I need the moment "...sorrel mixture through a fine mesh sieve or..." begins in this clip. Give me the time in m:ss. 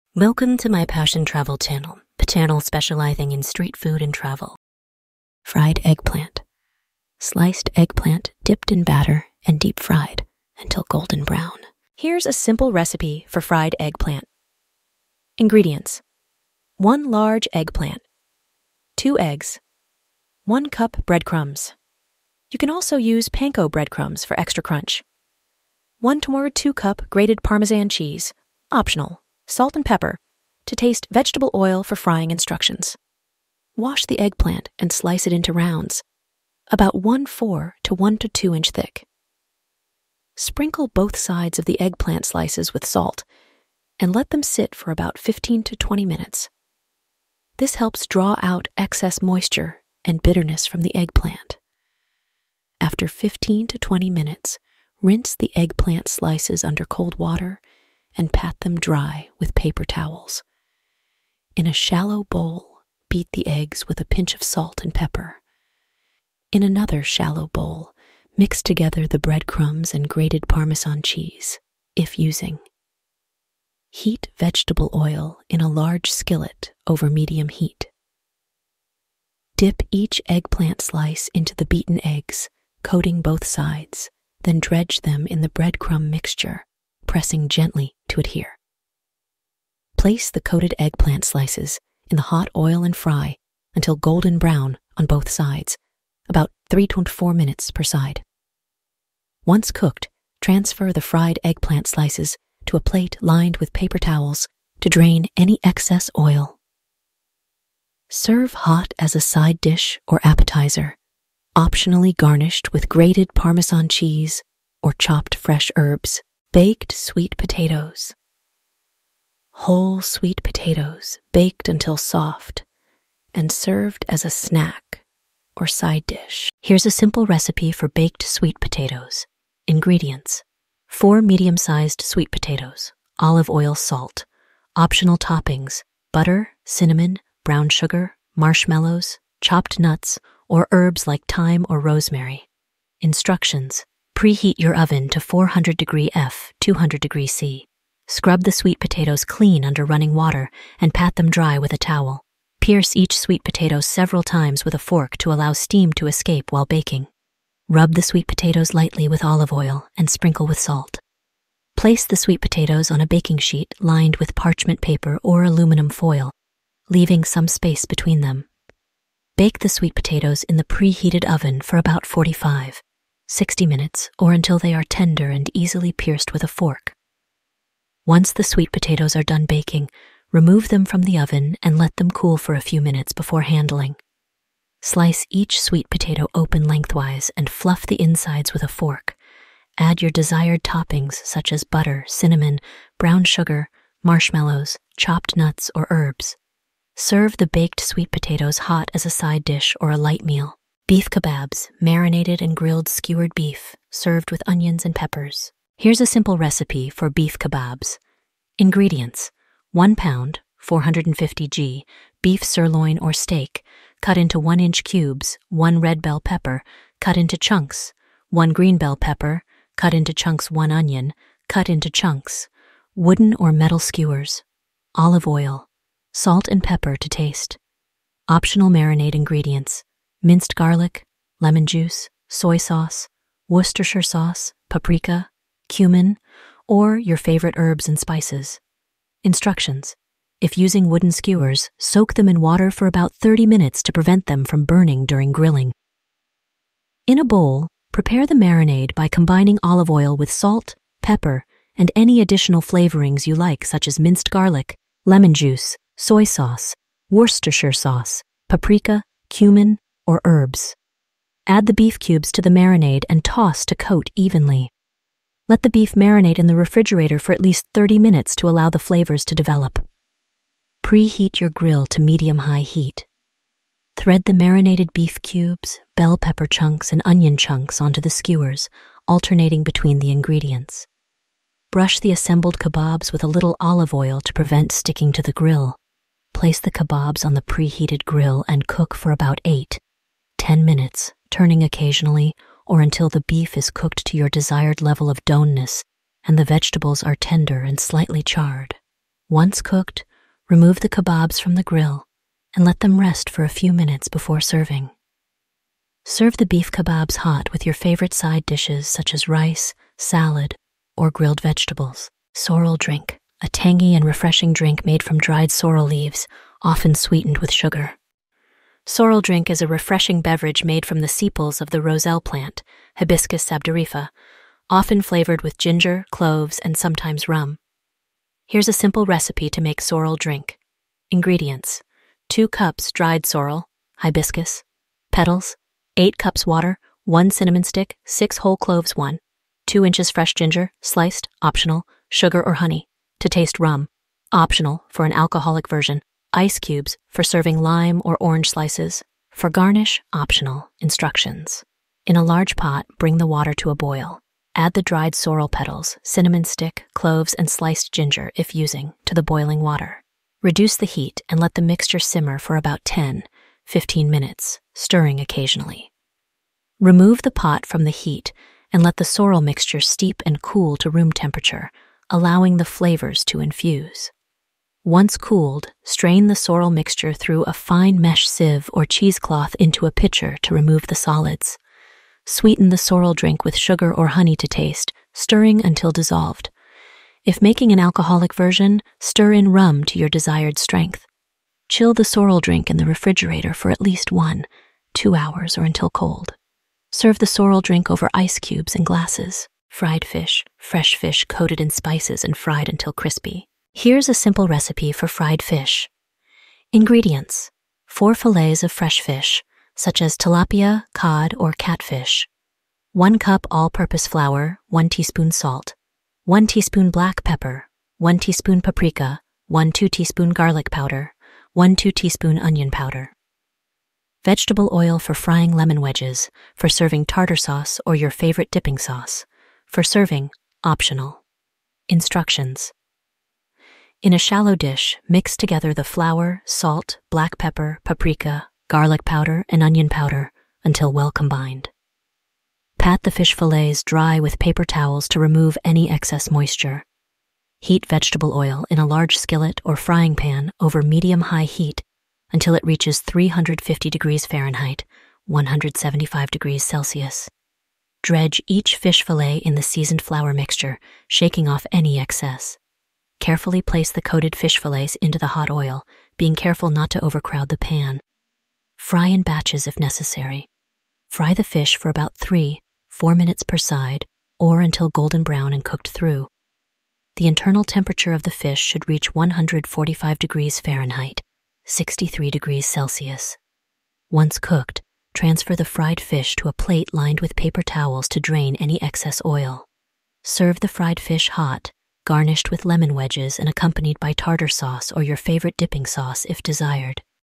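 6:16.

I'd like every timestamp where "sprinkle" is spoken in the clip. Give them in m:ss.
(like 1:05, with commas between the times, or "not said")
0:40, 2:40.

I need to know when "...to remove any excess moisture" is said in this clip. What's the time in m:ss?
7:25.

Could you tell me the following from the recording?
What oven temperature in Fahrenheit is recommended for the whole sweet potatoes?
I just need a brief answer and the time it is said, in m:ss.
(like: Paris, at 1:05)
400 degrees F, at 2:25.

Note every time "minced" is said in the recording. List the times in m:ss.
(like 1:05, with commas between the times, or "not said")
3:50, 4:13.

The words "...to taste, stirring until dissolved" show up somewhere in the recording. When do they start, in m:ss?
6:24.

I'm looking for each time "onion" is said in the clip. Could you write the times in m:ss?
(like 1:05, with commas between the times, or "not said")
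3:24, 3:40, 4:37, 7:02, 7:19.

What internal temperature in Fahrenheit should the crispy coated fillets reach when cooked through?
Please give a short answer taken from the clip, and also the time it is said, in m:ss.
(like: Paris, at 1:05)
145 degrees F, at 7:59.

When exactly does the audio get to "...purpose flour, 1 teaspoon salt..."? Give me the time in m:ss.
6:53.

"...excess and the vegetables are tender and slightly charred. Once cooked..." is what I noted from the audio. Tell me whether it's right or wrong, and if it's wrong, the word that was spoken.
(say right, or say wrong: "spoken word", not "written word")
wrong: "doneness", not "excess".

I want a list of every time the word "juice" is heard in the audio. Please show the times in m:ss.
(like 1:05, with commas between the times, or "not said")
3:51, 4:15.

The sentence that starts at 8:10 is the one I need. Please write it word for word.
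Serve the fried fish hot garnished with lemon wedges and accompanied by tartar sauce or your favorite dipping sauce if desired.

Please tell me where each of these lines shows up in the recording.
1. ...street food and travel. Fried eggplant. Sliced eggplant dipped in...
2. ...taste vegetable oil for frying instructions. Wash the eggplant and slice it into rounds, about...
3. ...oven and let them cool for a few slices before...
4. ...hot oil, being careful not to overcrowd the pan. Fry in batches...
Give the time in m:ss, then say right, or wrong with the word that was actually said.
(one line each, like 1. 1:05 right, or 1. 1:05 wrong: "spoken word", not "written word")
1. 0:03 right
2. 0:30 right
3. 3:01 wrong: "minutes", not "slices"
4. 7:45 right.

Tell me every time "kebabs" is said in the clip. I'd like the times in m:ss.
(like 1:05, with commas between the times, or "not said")
3:21, 3:27, 4:42, 4:46, 5:00, 5:06.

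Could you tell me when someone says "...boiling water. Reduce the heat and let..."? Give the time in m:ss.
5:59.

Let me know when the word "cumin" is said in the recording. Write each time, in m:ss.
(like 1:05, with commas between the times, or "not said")
3:55, 4:19.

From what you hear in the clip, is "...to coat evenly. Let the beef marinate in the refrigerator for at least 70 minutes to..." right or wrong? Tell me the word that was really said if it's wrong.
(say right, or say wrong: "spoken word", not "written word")
wrong: "30", not "70".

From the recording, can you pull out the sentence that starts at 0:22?
You can also use panko breadcrumbs for extra crunch.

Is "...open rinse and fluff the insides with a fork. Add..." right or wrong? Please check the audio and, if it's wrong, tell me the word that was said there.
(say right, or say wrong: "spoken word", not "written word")
wrong: "lengthwise", not "rinse".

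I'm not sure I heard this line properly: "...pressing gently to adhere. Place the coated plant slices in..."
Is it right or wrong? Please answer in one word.
wrong.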